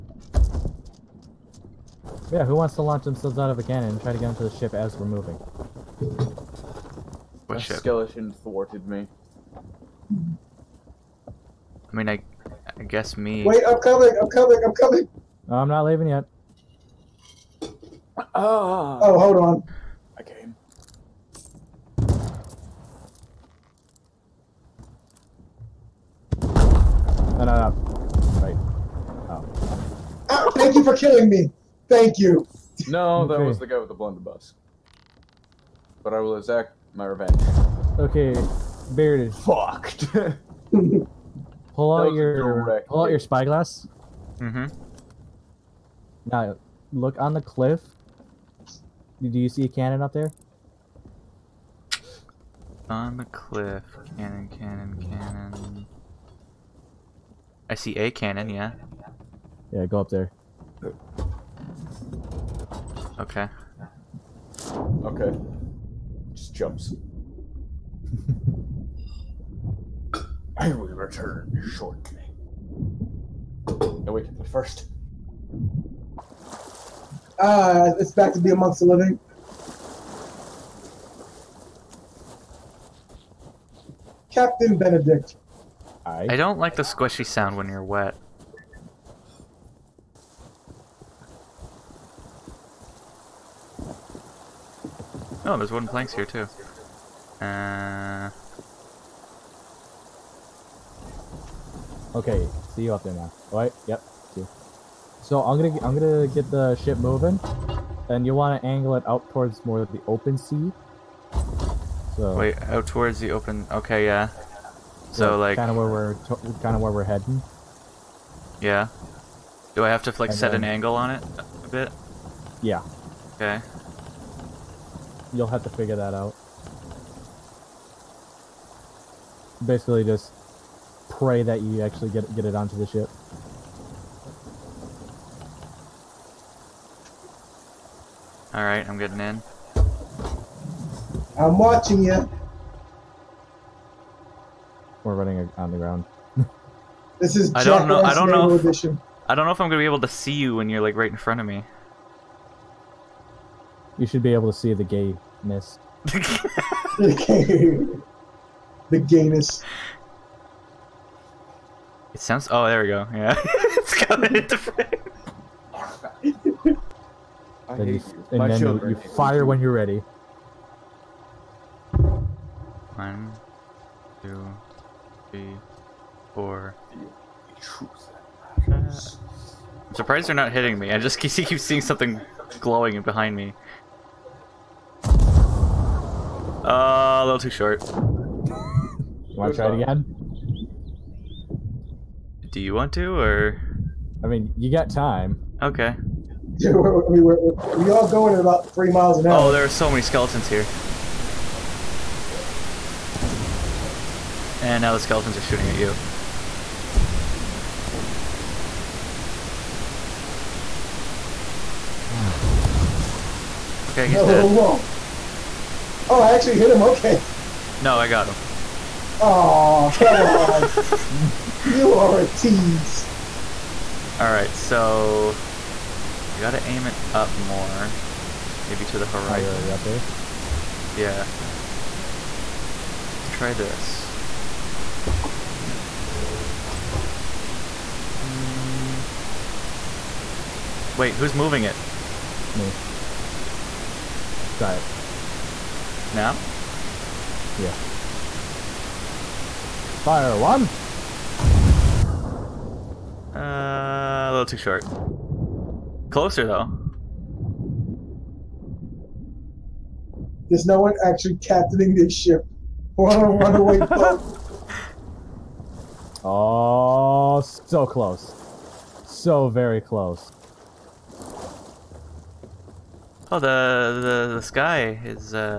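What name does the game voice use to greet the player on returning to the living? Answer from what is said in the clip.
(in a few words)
Captain Benedict.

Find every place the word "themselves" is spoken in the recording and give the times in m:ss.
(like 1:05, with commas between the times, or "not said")
0:03.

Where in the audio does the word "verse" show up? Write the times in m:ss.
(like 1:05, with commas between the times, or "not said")
not said.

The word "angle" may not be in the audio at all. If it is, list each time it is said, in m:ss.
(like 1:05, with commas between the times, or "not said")
1:48, 2:00.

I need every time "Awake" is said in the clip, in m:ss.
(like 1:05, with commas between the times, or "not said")
1:14.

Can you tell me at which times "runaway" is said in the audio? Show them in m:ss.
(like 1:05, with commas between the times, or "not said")
4:23.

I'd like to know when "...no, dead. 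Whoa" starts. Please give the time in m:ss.
3:34.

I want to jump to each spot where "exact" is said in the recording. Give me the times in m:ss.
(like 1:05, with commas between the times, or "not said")
0:36.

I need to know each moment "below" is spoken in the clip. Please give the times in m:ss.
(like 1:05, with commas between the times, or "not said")
not said.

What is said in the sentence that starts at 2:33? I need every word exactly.
You should be able to see the gayness.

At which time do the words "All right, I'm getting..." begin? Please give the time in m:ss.
2:18.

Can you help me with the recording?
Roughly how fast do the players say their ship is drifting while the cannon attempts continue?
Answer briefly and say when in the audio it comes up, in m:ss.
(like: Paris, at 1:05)
3 miles an hour, at 3:18.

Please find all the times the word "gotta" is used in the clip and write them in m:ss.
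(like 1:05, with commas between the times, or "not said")
3:46.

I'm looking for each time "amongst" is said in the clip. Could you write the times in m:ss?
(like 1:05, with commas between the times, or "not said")
1:18.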